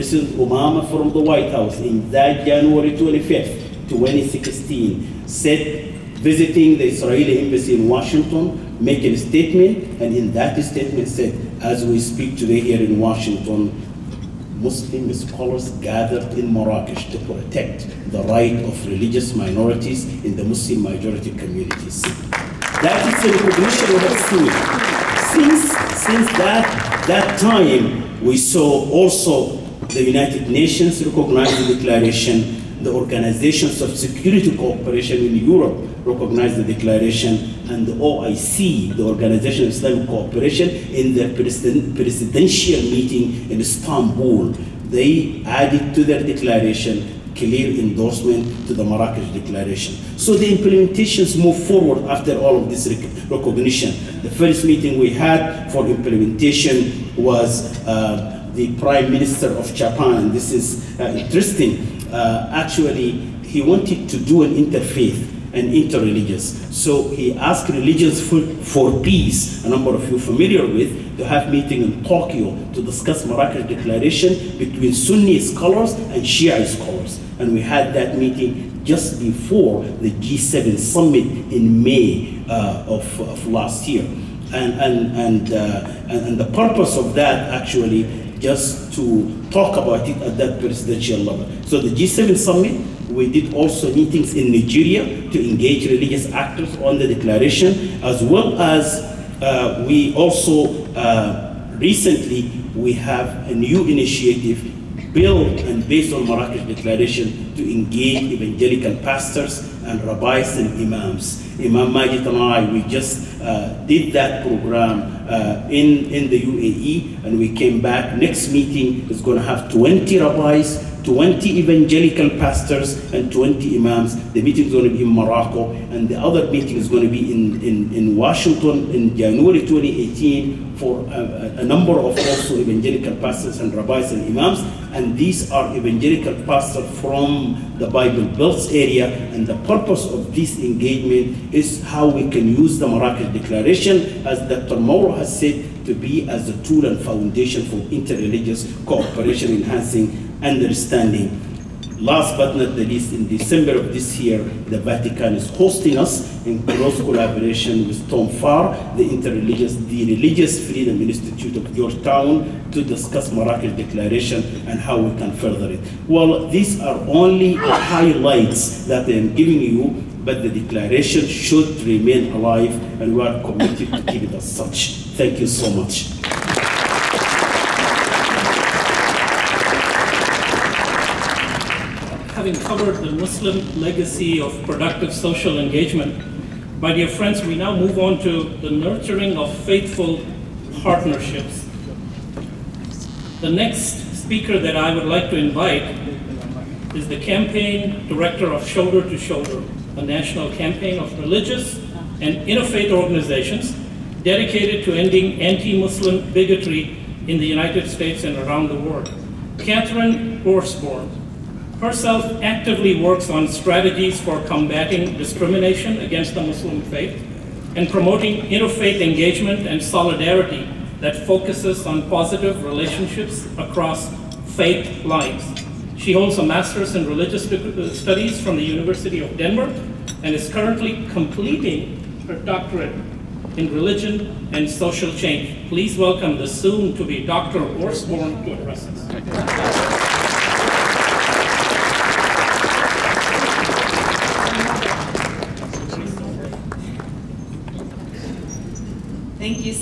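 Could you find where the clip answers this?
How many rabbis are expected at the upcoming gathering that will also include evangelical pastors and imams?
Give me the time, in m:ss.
1:59.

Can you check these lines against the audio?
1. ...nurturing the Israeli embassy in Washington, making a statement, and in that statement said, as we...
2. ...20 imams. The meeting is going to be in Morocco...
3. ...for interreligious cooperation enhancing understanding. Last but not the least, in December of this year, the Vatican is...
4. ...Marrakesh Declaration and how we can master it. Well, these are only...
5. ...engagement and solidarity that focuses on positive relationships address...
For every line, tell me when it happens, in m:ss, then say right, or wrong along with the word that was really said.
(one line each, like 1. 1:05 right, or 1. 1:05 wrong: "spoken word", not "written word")
1. 0:06 wrong: "visiting", not "nurturing"
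2. 2:03 right
3. 2:27 right
4. 2:43 wrong: "further", not "master"
5. 3:39 wrong: "across", not "address".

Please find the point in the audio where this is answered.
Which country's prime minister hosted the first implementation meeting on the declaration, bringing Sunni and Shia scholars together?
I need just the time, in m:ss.
0:59.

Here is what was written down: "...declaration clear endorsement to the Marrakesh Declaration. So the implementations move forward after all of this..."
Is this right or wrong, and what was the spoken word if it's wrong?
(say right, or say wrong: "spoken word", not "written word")
right.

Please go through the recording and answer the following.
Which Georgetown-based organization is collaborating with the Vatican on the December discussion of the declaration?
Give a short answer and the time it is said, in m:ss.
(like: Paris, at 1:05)
Religious Freedom Institute, at 2:39.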